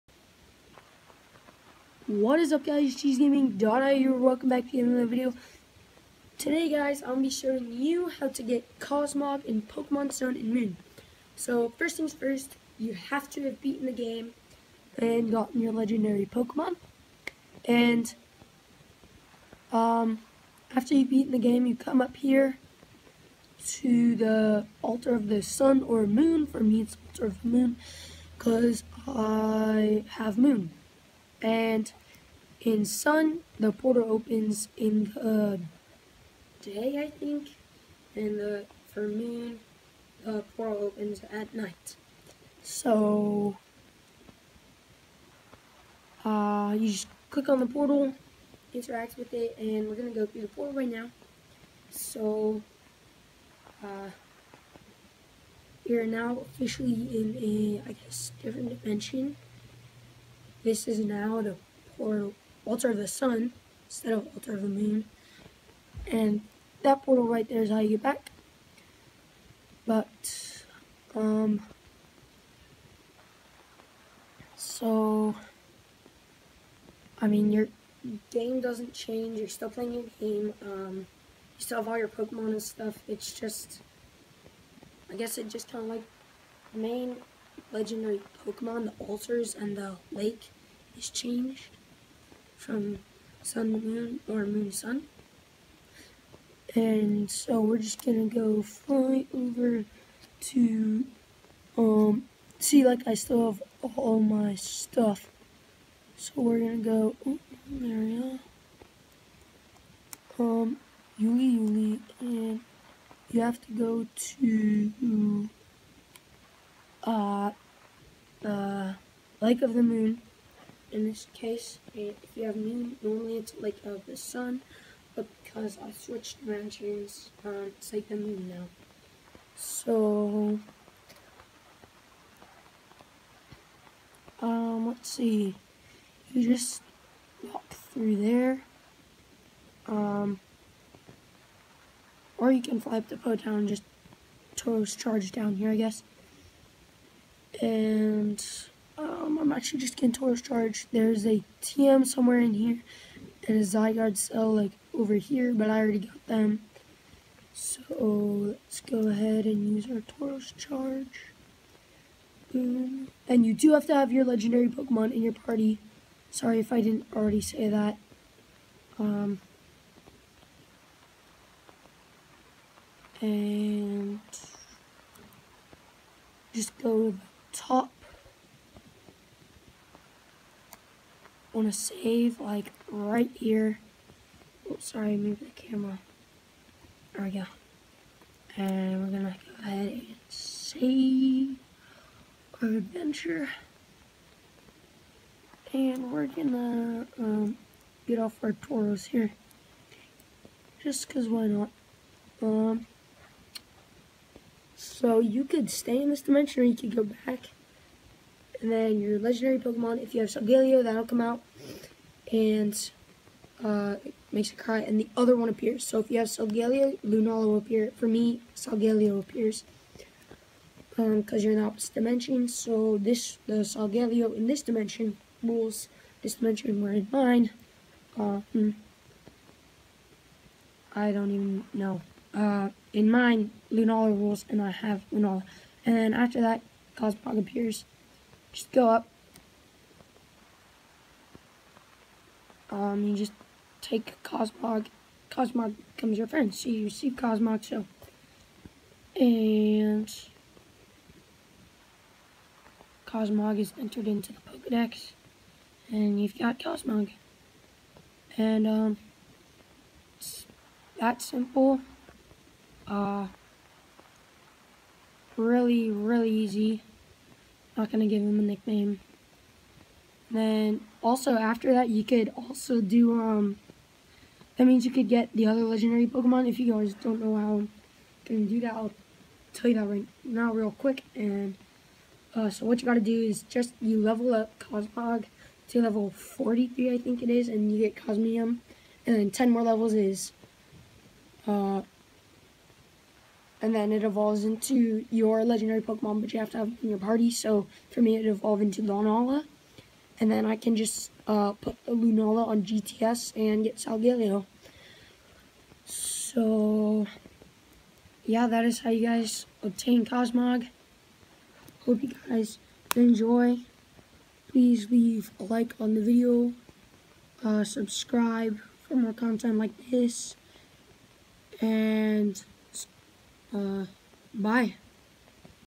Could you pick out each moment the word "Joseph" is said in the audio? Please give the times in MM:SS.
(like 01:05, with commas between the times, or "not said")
not said.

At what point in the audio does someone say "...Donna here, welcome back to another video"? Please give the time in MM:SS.
00:03.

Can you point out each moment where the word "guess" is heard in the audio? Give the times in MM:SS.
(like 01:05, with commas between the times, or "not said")
00:57, 01:25, 02:25.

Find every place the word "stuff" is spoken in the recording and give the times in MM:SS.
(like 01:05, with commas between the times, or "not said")
01:22, 01:44.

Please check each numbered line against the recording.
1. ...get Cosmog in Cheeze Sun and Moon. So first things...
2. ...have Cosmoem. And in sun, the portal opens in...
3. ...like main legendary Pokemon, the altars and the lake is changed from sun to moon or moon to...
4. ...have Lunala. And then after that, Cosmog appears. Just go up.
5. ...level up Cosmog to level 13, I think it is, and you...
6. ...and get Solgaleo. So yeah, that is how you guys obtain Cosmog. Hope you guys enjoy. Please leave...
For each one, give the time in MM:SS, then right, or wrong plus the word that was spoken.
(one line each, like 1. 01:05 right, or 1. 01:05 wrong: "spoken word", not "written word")
1. 00:08 wrong: "Pokemon", not "Cheeze"
2. 00:30 wrong: "Moon", not "Cosmoem"
3. 01:25 right
4. 03:54 right
5. 04:44 wrong: "43", not "13"
6. 05:03 right.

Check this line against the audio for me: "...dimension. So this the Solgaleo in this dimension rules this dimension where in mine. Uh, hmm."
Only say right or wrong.
right.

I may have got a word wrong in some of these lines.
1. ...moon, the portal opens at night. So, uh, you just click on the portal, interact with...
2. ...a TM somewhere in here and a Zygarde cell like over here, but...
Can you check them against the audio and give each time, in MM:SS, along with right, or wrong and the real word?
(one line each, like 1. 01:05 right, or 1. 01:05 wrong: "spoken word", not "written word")
1. 00:39 right
2. 02:31 right.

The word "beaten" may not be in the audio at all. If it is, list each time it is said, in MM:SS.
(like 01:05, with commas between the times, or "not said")
00:13, 00:21.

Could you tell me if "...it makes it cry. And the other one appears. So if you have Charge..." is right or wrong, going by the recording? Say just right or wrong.
wrong.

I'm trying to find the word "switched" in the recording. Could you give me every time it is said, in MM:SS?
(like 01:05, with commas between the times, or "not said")
02:05.